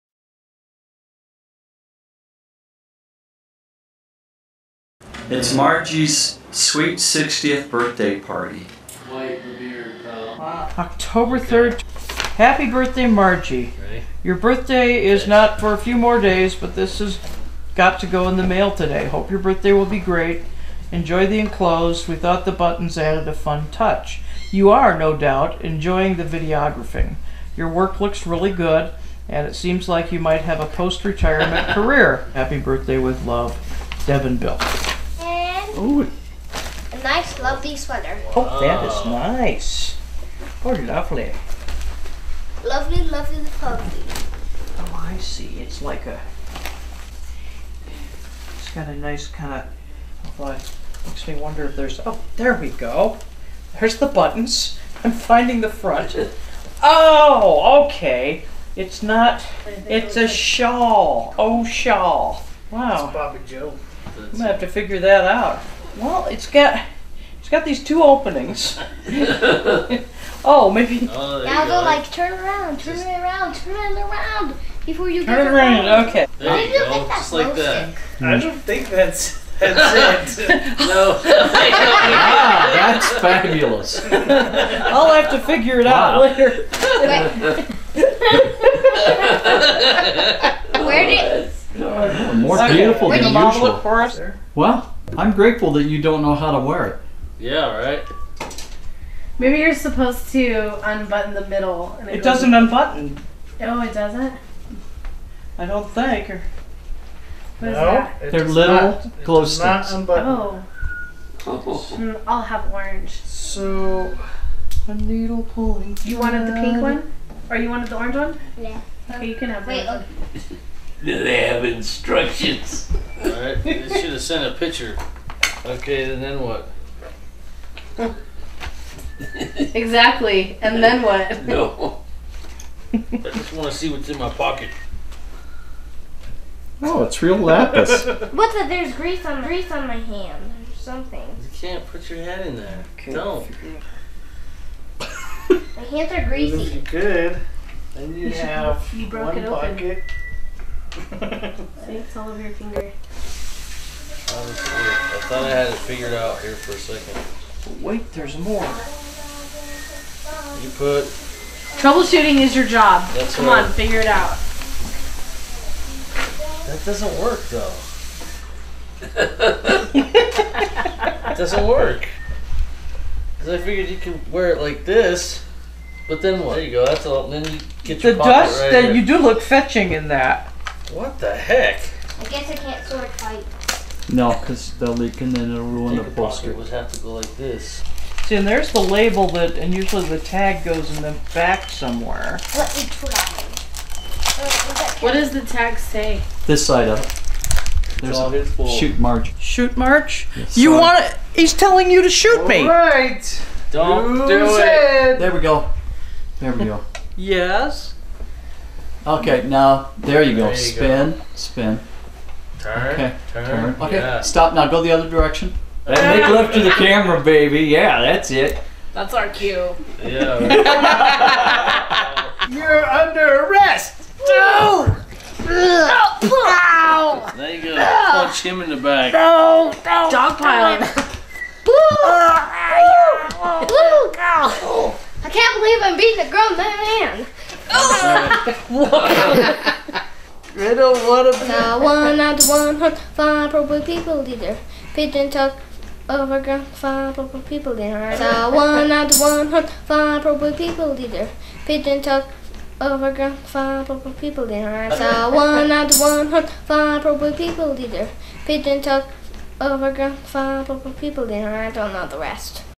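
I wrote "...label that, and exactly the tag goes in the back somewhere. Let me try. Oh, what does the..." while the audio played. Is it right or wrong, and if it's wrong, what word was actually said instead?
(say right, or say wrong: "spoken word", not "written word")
wrong: "usually", not "exactly".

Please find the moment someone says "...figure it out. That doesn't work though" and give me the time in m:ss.
2:43.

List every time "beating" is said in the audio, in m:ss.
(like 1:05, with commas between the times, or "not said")
3:55.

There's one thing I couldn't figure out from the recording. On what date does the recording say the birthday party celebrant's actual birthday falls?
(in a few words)
October 3rd.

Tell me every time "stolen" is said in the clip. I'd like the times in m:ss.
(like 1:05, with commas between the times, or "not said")
not said.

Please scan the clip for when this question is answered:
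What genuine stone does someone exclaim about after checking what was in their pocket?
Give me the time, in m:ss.
2:17.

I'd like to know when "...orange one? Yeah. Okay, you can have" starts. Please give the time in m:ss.
1:57.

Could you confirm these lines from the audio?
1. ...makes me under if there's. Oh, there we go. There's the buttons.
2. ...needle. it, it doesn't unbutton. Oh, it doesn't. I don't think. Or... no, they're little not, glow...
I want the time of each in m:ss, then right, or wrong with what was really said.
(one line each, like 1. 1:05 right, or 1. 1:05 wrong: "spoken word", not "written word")
1. 0:51 wrong: "wonder", not "under"
2. 1:41 wrong: "middle", not "needle".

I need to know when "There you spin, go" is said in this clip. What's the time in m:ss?
3:30.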